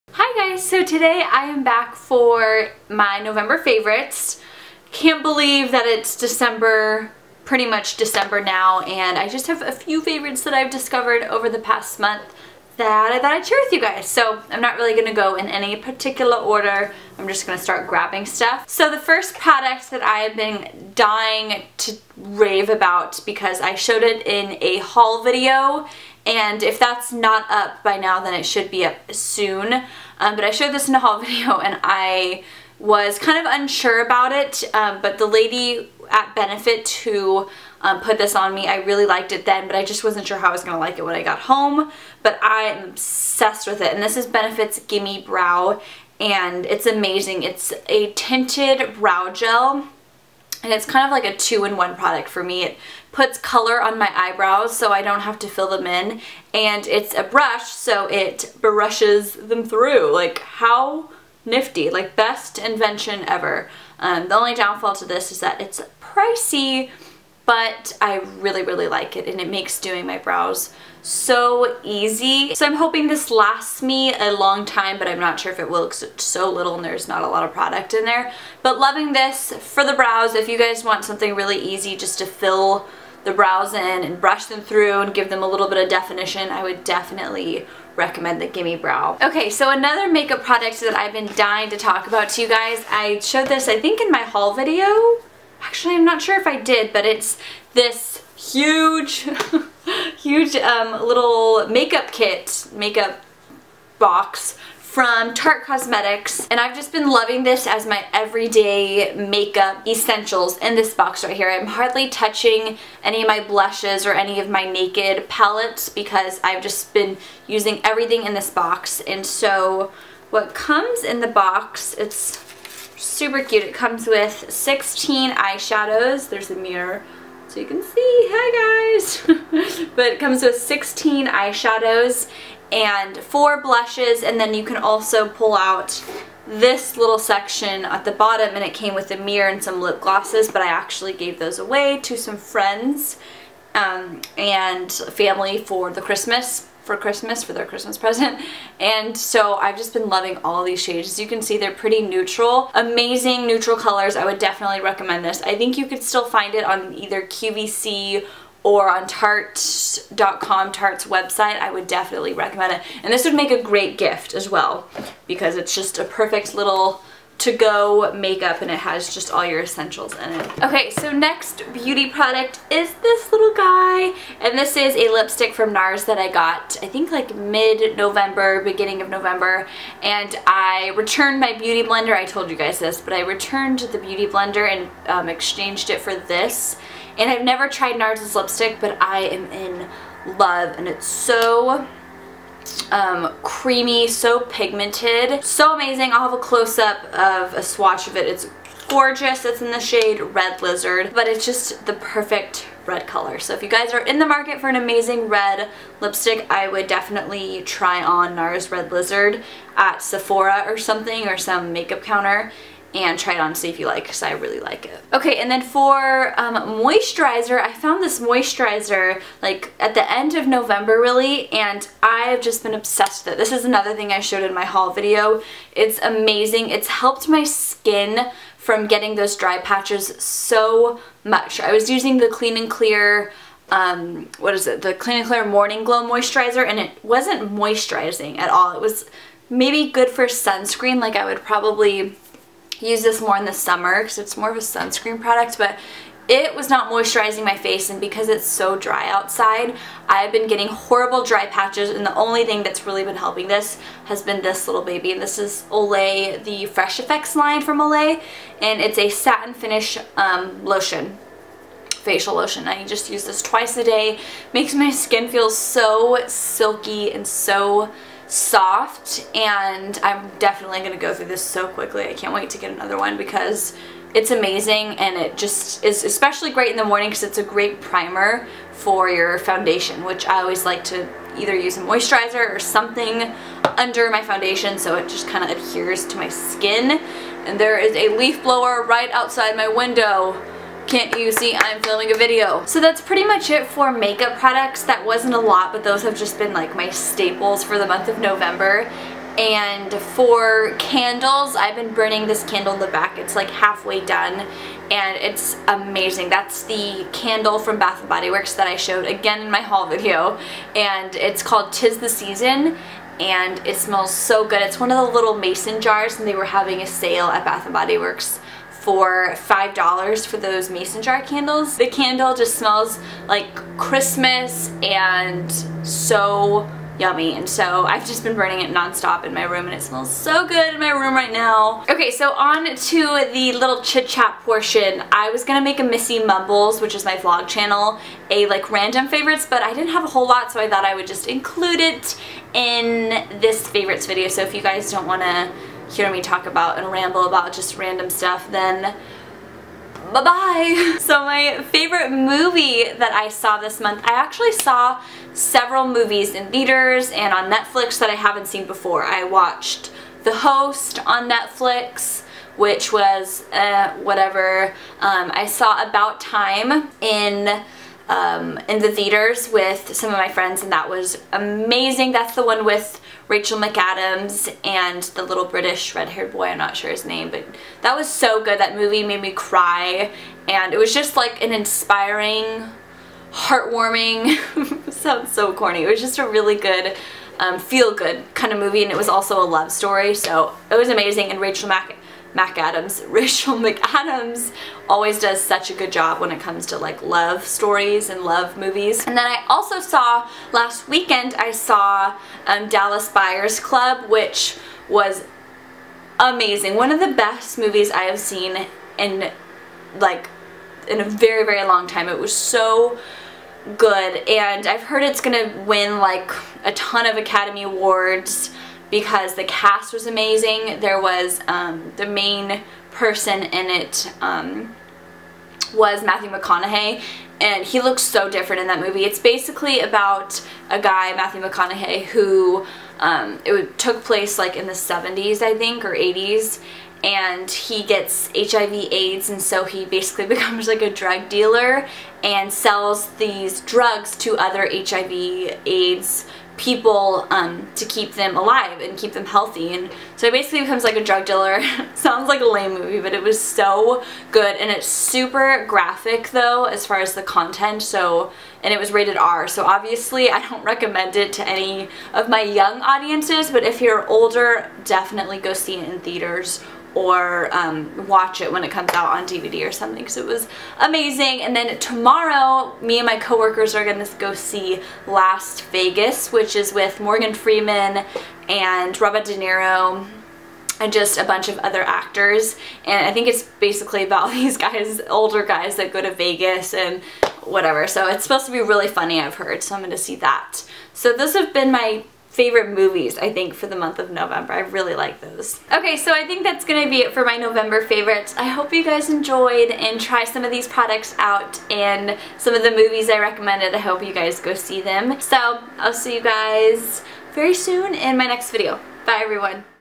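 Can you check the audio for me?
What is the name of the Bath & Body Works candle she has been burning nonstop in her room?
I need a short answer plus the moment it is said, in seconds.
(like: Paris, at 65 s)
Tis the Season, at 311 s.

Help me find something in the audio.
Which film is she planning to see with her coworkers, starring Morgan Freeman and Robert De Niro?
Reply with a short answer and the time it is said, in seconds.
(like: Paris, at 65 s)
Last Vegas, at 475 s.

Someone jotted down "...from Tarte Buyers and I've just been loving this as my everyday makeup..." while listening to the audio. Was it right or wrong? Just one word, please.
wrong.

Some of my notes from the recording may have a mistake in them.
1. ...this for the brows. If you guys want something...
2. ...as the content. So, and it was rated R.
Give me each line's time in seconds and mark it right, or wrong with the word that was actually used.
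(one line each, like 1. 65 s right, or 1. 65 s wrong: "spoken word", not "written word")
1. 79 s right
2. 457 s right.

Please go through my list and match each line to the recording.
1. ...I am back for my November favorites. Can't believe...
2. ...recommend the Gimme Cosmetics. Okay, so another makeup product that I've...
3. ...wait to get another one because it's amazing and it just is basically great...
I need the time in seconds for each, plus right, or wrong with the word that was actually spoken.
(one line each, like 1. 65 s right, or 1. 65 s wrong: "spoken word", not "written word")
1. 1 s right
2. 87 s wrong: "Brow", not "Cosmetics"
3. 272 s wrong: "especially", not "basically".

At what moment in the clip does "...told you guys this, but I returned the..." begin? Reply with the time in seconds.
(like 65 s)
182 s.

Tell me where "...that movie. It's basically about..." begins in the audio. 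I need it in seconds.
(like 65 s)
428 s.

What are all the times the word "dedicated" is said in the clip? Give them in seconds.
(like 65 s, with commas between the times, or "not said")
not said.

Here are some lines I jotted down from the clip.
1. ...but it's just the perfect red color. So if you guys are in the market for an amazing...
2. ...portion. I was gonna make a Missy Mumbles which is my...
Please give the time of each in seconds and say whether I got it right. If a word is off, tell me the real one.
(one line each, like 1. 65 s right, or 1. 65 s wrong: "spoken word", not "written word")
1. 201 s right
2. 334 s right.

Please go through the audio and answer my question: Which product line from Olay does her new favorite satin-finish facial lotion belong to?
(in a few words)
Fresh Effects.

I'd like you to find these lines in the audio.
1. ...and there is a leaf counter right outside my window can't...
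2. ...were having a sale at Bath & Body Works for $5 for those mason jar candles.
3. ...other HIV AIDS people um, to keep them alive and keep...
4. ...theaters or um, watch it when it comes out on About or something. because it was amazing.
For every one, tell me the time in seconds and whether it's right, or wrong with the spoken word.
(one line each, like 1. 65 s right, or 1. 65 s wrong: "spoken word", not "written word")
1. 287 s wrong: "blower", not "counter"
2. 316 s right
3. 444 s right
4. 465 s wrong: "DVD", not "About".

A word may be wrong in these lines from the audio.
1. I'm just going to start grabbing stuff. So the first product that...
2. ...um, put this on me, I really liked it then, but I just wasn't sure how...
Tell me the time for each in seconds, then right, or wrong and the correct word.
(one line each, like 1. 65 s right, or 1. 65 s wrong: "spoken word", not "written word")
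1. 17 s right
2. 37 s right.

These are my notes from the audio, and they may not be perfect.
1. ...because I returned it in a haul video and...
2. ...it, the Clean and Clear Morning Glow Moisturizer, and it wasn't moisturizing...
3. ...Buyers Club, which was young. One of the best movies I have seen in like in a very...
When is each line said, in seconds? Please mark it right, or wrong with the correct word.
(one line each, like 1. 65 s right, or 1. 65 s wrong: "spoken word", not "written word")
1. 23 s wrong: "showed", not "returned"
2. 234 s right
3. 403 s wrong: "amazing", not "young".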